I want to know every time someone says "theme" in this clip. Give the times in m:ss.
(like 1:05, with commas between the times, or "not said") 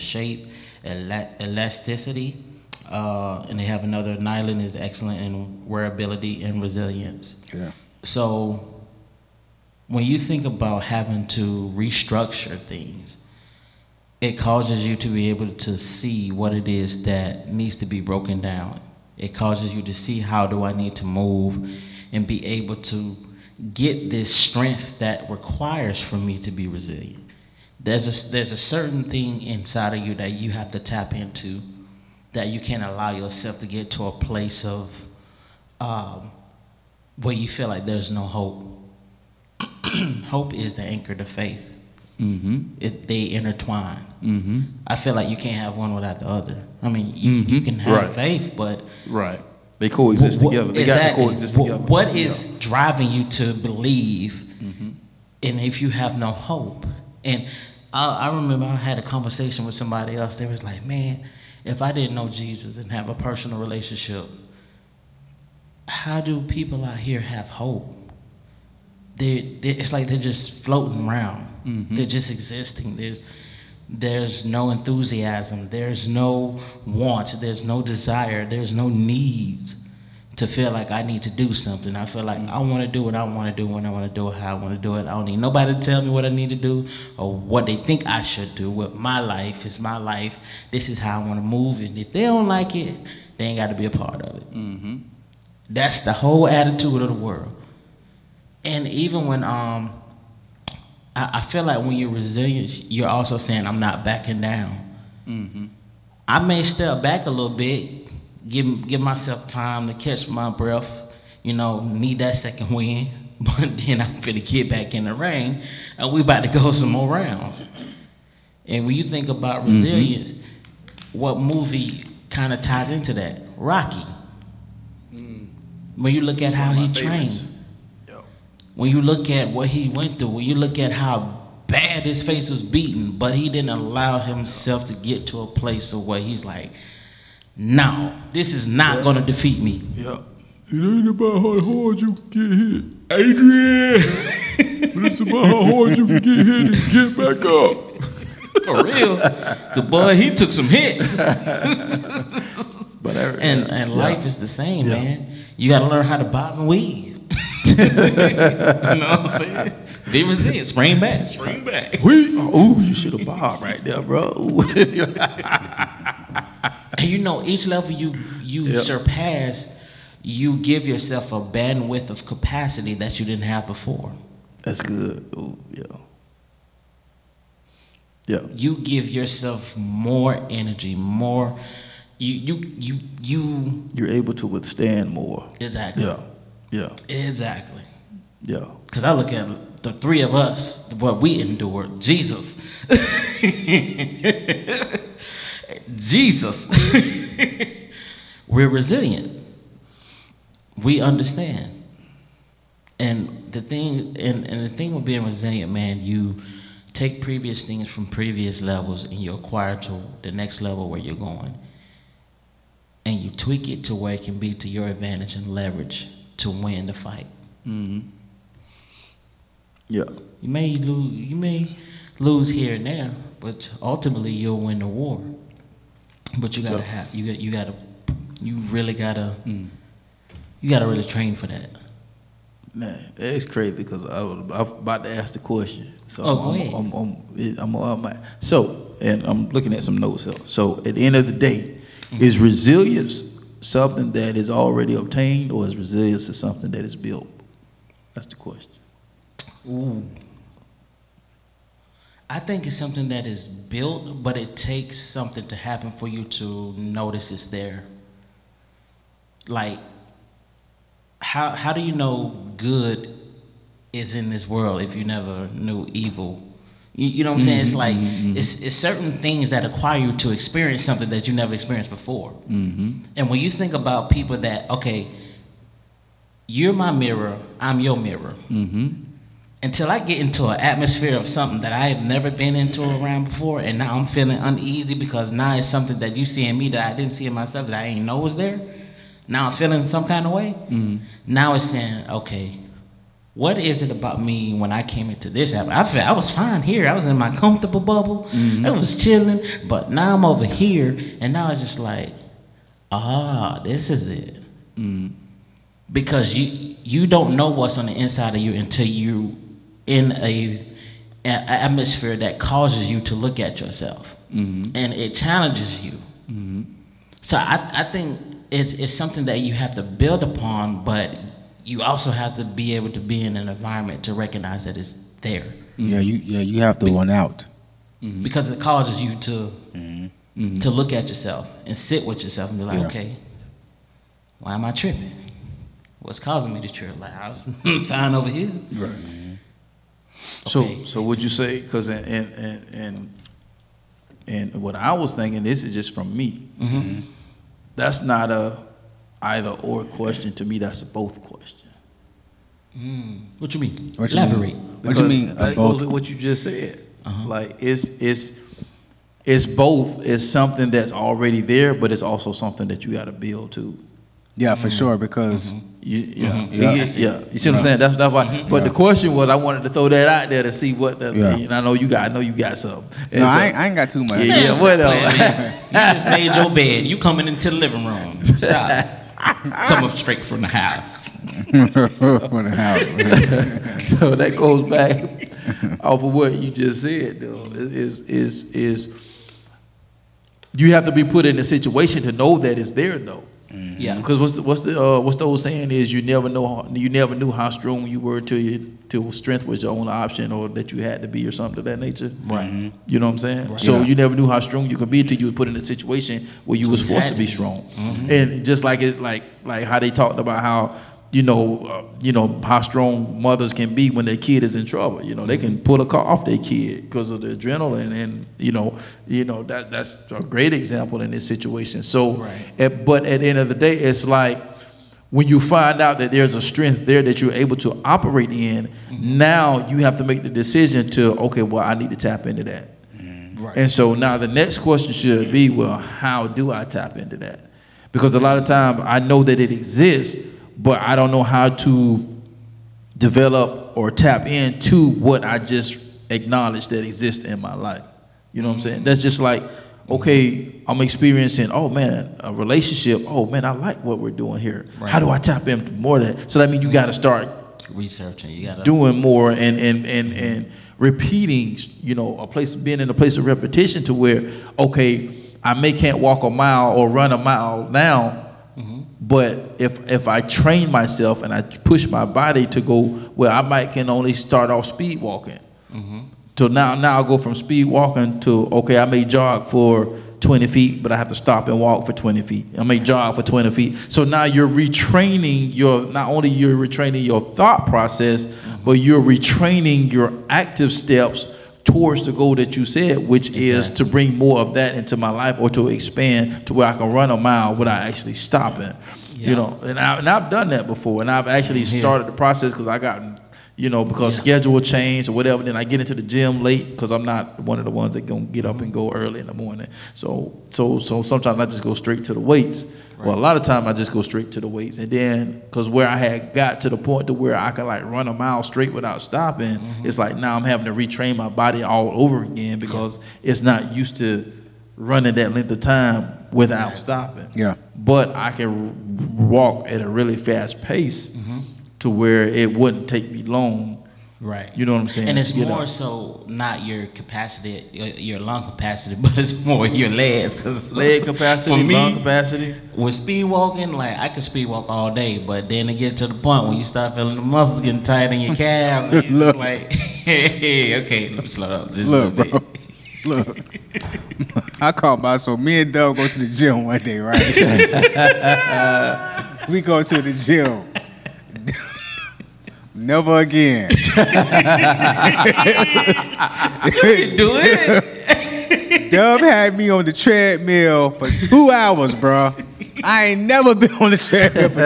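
not said.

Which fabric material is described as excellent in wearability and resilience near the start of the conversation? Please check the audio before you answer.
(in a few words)
Nylon.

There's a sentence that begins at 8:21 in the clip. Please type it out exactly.
started the process because I got, you know, because yeah.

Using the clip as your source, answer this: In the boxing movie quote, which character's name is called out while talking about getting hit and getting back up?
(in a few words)
Adrian.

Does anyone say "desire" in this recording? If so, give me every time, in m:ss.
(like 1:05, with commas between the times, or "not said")
1:17.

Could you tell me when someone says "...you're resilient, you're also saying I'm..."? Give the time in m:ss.
1:41.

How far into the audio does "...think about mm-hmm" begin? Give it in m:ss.
1:59.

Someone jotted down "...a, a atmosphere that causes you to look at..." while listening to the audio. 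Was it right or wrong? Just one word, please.
right.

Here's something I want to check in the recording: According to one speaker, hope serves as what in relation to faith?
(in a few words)
The anchor.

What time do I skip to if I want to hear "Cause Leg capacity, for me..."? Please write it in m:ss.
9:00.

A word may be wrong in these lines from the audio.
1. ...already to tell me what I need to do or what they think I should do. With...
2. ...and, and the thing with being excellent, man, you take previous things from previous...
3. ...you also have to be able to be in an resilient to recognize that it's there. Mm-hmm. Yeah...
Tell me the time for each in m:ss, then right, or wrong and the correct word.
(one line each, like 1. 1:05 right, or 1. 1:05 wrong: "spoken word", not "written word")
1. 1:25 wrong: "nobody", not "already"
2. 3:24 wrong: "resilient", not "excellent"
3. 5:21 wrong: "environment", not "resilient".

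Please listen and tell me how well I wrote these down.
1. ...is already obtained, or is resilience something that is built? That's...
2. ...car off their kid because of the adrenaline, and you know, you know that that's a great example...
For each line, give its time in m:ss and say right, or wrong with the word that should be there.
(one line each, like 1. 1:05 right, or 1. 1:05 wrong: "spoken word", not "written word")
1. 4:04 right
2. 6:55 right.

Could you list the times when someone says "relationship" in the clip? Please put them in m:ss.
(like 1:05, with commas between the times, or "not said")
1:03, 7:32.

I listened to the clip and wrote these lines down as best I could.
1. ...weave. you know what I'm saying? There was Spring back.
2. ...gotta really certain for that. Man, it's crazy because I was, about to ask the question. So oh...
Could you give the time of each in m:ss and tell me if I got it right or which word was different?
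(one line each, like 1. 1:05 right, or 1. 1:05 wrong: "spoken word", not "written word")
1. 2:36 right
2. 3:50 wrong: "train", not "certain".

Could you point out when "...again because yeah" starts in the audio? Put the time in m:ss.
8:42.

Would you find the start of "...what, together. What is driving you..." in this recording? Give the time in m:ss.
0:51.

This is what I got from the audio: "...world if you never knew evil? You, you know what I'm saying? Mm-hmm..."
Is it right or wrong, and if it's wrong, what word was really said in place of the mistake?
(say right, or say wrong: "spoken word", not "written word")
right.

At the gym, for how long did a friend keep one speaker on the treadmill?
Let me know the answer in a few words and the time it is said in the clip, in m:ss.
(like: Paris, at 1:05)
2 hours, at 9:31.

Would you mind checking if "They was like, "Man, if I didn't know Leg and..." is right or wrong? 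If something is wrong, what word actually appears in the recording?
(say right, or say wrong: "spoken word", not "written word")
wrong: "Jesus", not "Leg".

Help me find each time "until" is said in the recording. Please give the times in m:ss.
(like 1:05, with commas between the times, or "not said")
4:39, 5:08, 6:45.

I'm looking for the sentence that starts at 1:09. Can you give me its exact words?
They, they it's like they're just floating around.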